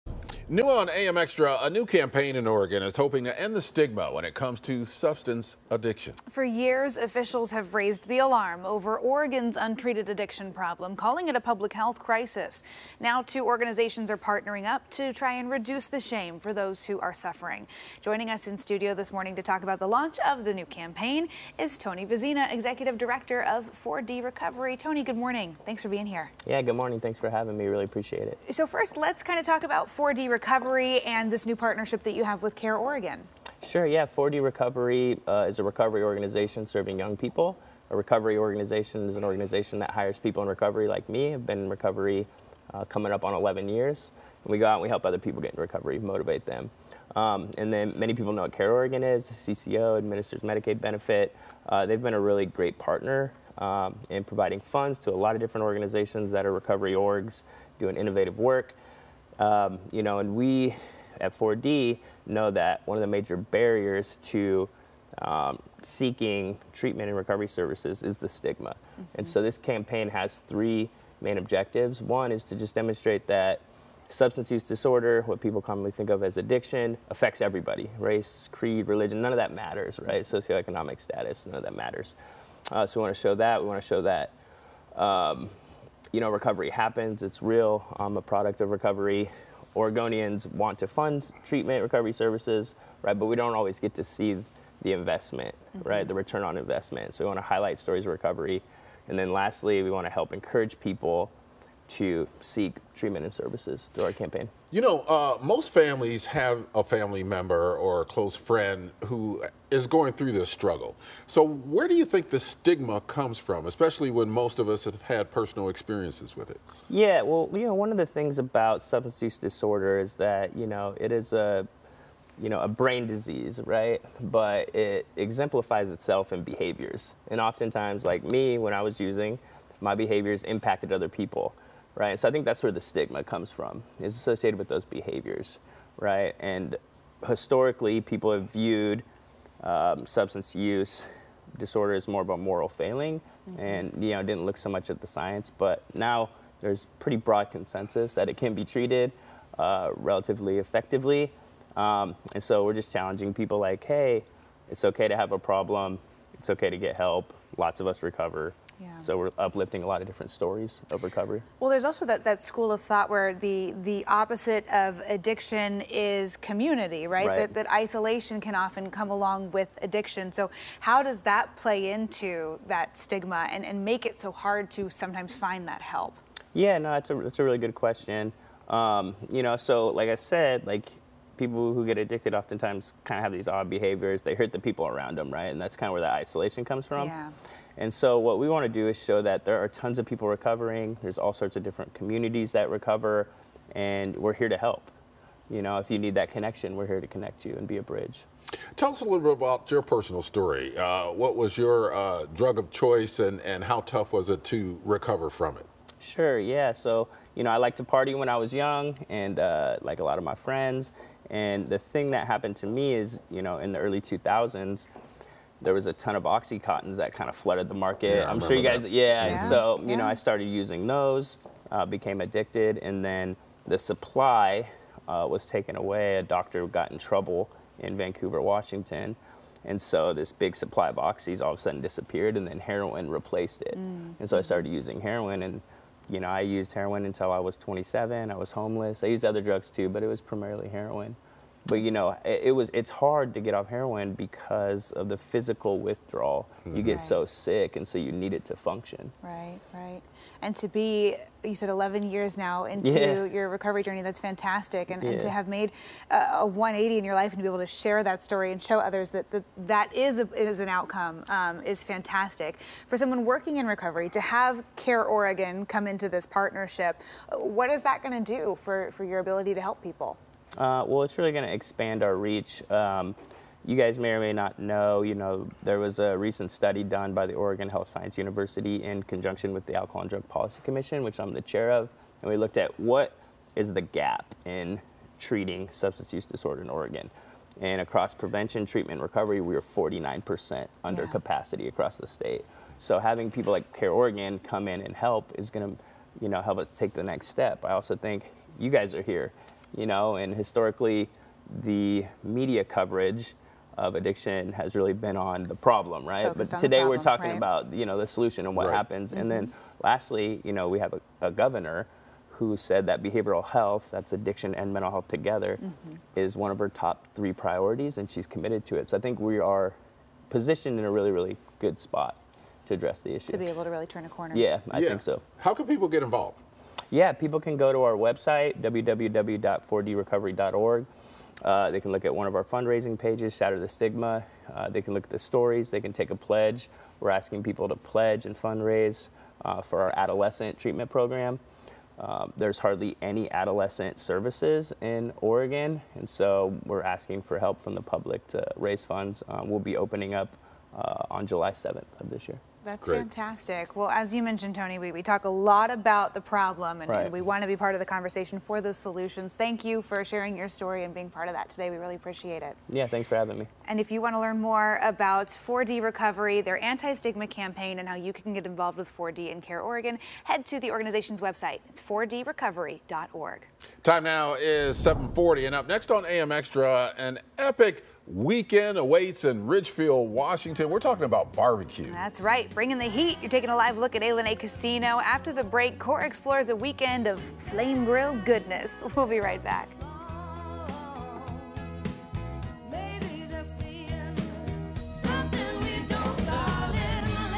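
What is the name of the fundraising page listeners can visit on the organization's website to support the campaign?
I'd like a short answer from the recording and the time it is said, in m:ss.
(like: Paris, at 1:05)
Shatter the Stigma, at 5:33.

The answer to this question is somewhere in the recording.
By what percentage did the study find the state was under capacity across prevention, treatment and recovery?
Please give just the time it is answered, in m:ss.
4:49.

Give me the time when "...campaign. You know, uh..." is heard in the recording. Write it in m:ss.
1:44.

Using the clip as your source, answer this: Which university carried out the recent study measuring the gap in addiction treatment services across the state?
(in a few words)
Oregon Health Science University.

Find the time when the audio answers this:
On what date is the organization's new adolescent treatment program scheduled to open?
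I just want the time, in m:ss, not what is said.
5:51.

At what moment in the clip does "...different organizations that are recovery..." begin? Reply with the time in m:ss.
0:55.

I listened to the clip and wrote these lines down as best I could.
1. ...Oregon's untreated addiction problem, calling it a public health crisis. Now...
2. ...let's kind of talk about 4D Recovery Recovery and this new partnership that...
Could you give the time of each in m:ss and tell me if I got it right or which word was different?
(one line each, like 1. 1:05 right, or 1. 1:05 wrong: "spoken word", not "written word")
1. 0:08 right
2. 0:28 right.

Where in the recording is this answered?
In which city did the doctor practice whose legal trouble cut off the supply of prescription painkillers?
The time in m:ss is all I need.
3:47.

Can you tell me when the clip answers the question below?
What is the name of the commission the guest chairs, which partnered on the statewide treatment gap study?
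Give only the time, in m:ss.
4:39.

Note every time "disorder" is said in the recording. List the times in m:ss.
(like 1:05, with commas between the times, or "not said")
1:14, 1:59, 2:21, 4:46.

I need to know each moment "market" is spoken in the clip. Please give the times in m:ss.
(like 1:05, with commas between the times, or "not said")
3:37.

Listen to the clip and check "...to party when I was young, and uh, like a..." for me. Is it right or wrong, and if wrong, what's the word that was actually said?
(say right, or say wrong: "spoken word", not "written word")
right.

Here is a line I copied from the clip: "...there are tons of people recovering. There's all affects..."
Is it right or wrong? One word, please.
wrong.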